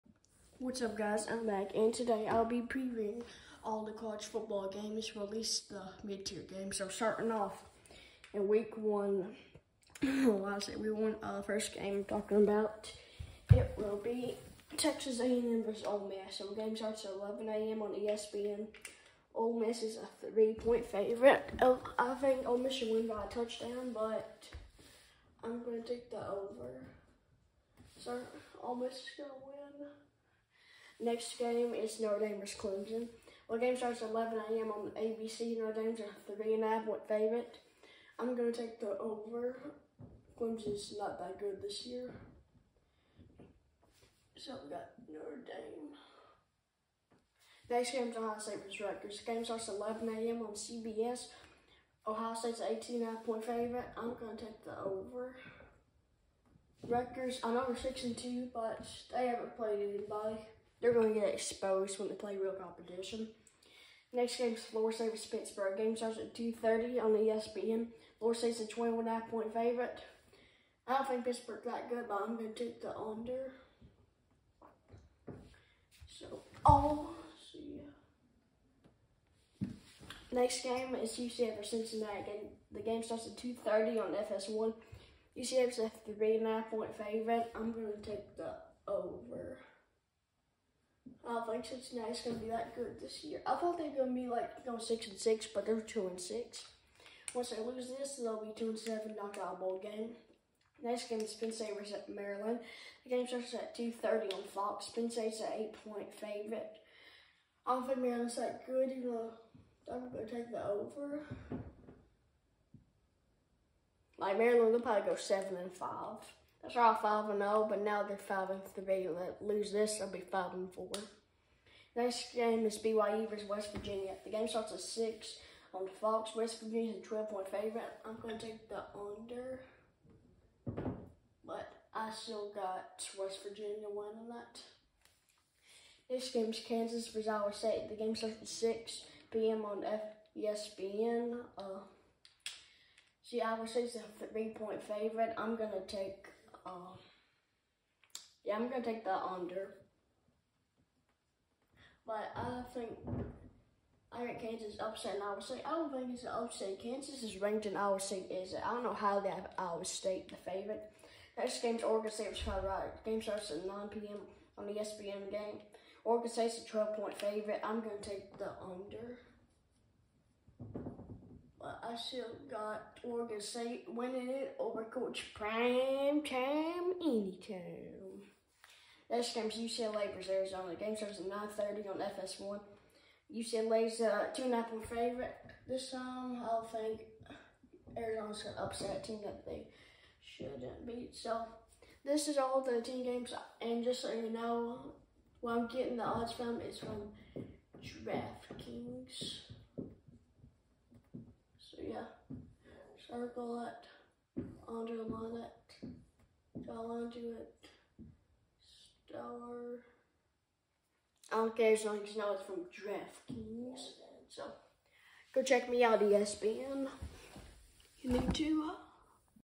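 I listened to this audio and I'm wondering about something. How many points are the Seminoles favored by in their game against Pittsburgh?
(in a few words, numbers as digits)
21.5.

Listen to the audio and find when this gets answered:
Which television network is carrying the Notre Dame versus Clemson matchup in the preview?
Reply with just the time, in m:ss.
0:34.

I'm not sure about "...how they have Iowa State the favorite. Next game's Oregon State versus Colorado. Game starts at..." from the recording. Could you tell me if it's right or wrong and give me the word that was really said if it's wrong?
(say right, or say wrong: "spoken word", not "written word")
right.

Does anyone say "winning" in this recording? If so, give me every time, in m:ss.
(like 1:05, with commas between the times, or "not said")
2:13, 2:53.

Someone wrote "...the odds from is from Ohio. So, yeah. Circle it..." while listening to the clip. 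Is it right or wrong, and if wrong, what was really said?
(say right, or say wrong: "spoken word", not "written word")
wrong: "DraftKings", not "Ohio".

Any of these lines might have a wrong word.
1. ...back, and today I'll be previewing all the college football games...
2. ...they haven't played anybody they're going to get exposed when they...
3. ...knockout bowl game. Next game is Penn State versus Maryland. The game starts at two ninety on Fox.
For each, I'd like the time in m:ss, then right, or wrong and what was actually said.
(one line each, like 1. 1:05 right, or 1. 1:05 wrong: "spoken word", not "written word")
1. 0:01 right
2. 0:59 right
3. 1:39 wrong: "thirty", not "ninety".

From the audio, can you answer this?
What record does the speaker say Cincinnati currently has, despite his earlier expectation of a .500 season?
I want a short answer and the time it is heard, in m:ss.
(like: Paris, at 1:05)
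2-6, at 1:35.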